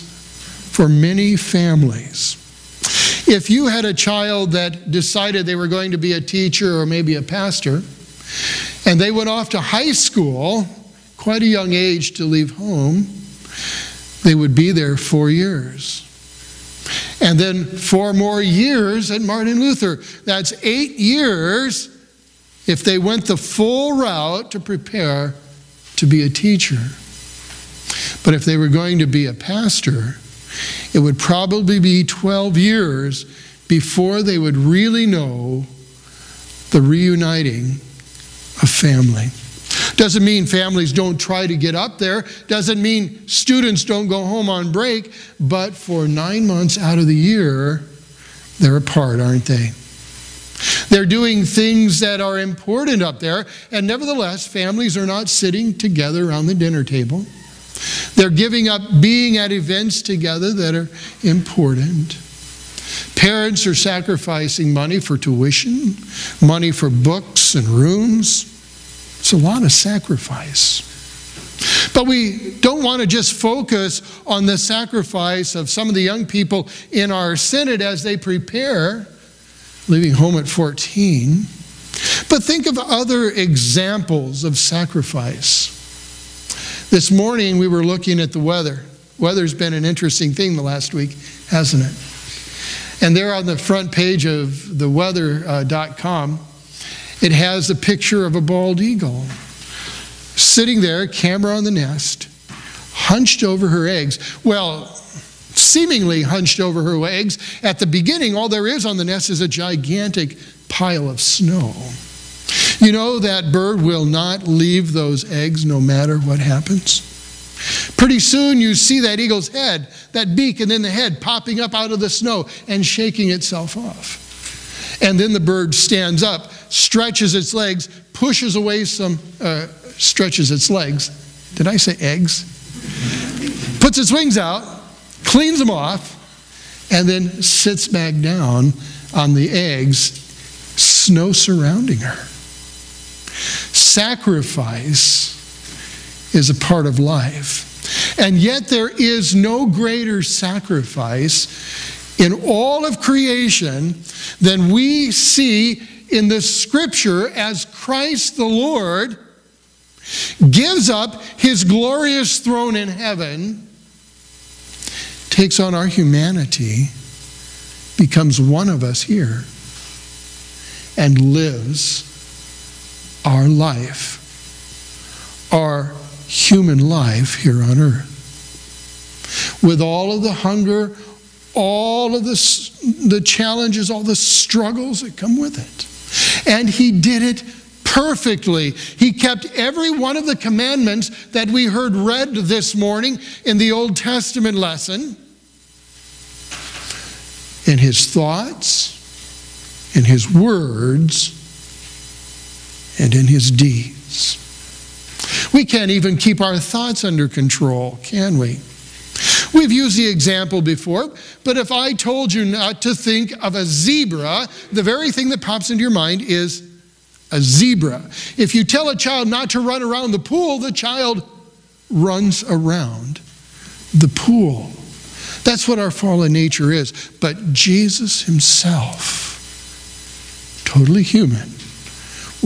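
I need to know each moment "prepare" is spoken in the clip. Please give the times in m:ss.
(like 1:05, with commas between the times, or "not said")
0:24, 1:18.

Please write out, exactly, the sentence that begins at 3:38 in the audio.
If you tell a child not to run around the pool, the child runs around the pool.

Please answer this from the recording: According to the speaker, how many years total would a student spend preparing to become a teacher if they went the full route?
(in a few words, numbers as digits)
8.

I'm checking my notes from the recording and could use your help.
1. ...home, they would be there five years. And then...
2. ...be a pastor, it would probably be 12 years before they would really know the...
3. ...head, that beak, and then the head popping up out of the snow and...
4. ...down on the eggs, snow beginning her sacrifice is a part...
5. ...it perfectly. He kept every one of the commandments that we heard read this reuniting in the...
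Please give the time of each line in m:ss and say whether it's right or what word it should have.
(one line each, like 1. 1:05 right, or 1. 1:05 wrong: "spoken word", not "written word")
1. 0:12 wrong: "four", not "five"
2. 0:29 right
3. 1:59 right
4. 2:18 wrong: "surrounding", not "beginning"
5. 3:07 wrong: "morning", not "reuniting".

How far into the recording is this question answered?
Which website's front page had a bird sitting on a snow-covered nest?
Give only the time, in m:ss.
1:34.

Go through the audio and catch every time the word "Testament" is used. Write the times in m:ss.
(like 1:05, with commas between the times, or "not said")
3:13.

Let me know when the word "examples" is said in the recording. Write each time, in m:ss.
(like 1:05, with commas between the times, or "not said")
1:23, 3:30.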